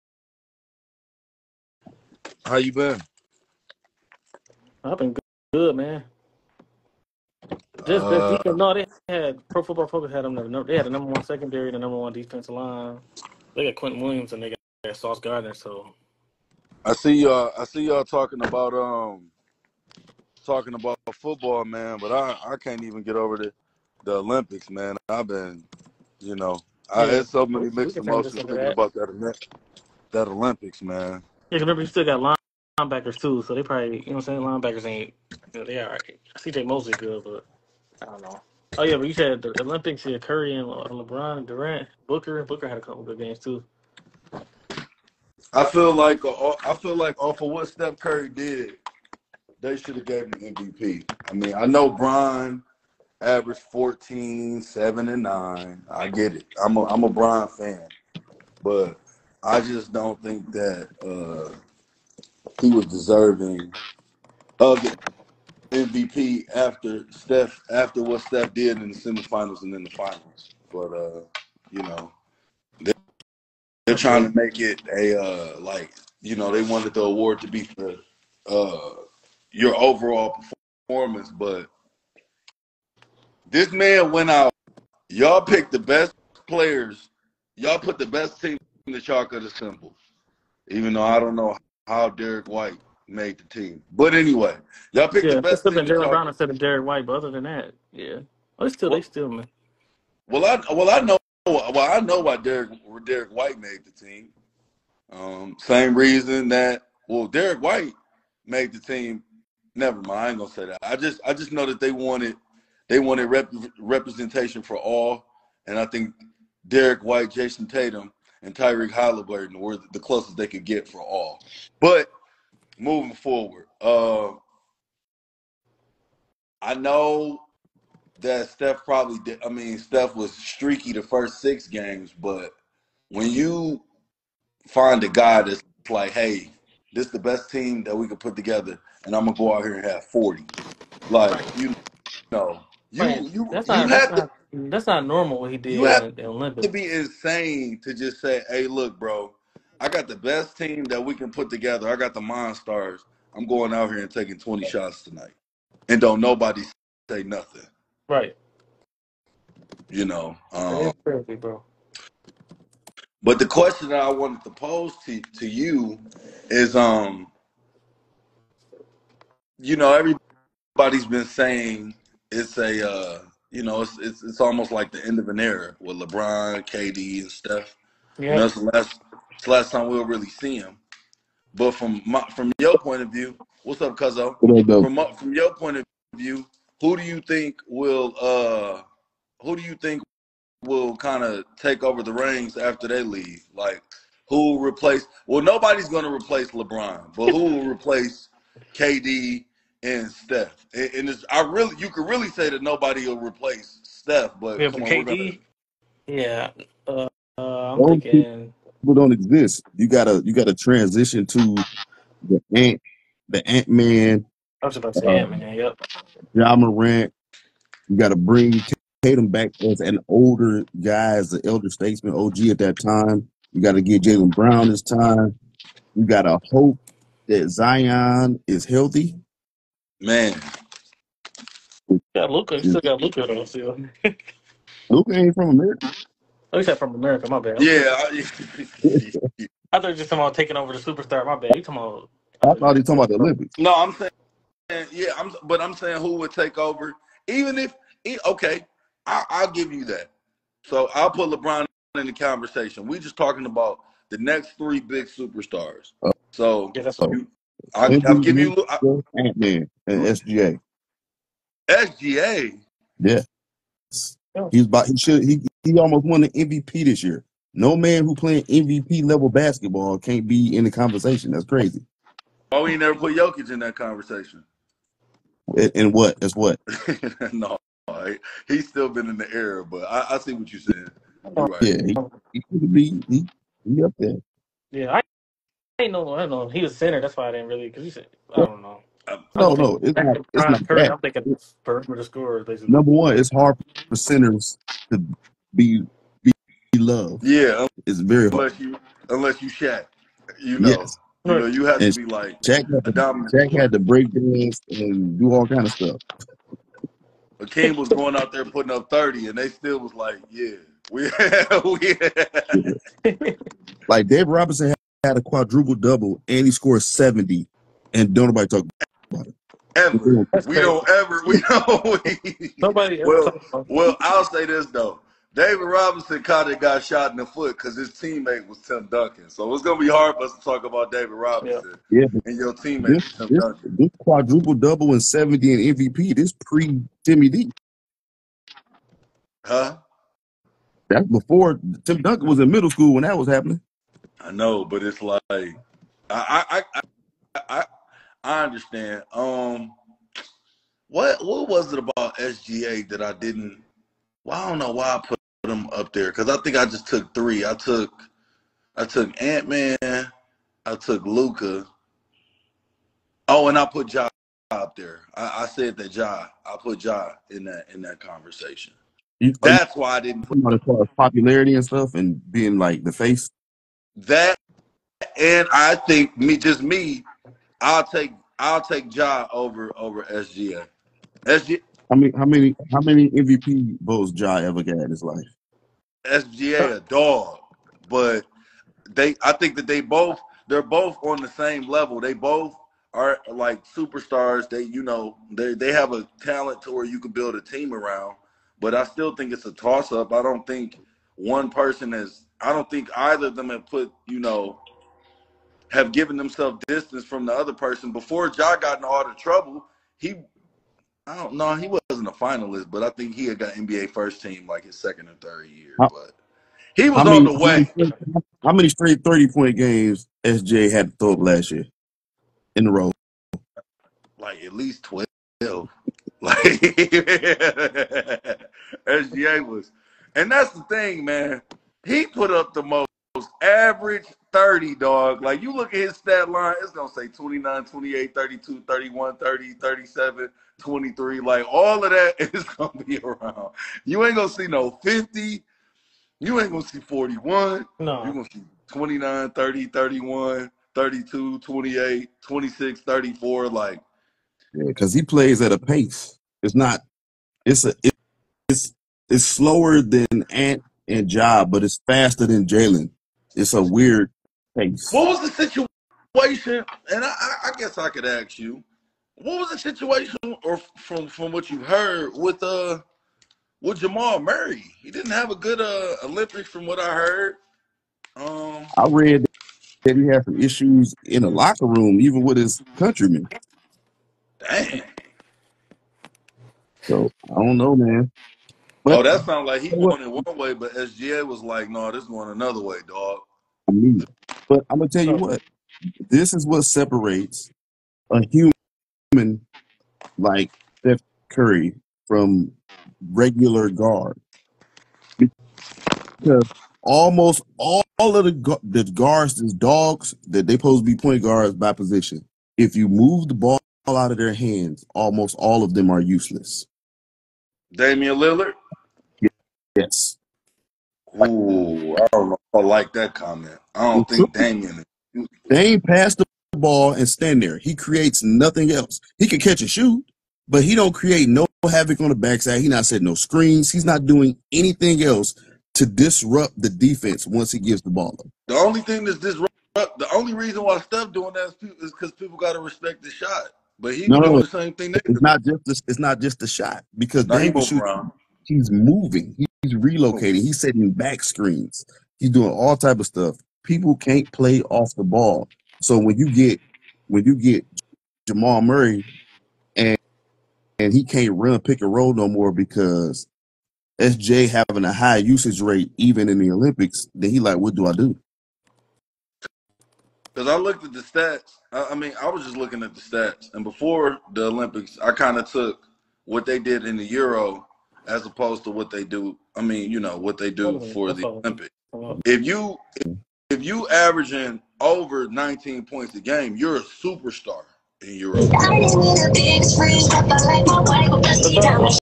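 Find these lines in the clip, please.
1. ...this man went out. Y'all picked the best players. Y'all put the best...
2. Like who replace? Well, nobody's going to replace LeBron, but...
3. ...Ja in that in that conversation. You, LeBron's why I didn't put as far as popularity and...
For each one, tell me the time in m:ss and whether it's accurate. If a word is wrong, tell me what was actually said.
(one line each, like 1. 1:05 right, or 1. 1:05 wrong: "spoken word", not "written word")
1. 1:23 right
2. 3:13 right
3. 6:06 wrong: "That", not "LeBron".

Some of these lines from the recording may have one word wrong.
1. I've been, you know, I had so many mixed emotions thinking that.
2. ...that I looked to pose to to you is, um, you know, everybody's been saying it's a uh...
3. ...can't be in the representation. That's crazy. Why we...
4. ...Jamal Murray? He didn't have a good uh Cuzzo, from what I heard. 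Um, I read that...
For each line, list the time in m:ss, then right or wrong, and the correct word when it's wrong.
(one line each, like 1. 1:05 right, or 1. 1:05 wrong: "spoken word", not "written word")
1. 0:25 right
2. 2:43 wrong: "wanted", not "looked"
3. 4:29 wrong: "conversation", not "representation"
4. 7:53 wrong: "Olympics", not "Cuzzo".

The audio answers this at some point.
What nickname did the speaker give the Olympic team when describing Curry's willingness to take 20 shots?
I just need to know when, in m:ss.
2:32.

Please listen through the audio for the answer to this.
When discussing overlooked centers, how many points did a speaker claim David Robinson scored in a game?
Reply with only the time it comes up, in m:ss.
5:16.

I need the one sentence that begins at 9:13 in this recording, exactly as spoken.
People can't play off the ball.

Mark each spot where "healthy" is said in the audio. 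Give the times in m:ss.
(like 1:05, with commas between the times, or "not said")
3:48.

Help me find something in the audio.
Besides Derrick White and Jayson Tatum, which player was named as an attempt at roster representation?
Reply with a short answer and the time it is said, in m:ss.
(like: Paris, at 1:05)
Tyrese Haliburton, at 1:58.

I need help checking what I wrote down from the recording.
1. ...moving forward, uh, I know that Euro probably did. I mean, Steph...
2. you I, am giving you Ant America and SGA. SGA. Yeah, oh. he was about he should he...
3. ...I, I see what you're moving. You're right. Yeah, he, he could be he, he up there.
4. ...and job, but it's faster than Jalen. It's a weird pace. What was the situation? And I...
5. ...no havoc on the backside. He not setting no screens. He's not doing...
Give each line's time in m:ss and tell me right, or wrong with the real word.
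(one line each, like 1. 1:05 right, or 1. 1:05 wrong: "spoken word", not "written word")
1. 2:02 wrong: "Steph", not "Euro"
2. 4:17 wrong: "Man", not "America"
3. 4:39 wrong: "saying", not "moving"
4. 7:40 right
5. 8:51 right.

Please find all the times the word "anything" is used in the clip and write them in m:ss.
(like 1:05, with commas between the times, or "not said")
8:54.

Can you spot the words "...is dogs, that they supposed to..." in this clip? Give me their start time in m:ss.
8:29.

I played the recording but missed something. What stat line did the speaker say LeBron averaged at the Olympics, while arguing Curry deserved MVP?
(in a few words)
14, 7, and 9.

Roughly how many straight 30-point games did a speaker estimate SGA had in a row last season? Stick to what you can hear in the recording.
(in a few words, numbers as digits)
12.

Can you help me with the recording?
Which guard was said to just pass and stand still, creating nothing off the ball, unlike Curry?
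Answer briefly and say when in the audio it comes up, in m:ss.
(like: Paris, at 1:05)
Damian Lillard, at 8:37.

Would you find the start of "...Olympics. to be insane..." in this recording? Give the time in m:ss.
2:26.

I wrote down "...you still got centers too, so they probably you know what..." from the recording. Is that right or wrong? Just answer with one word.
wrong.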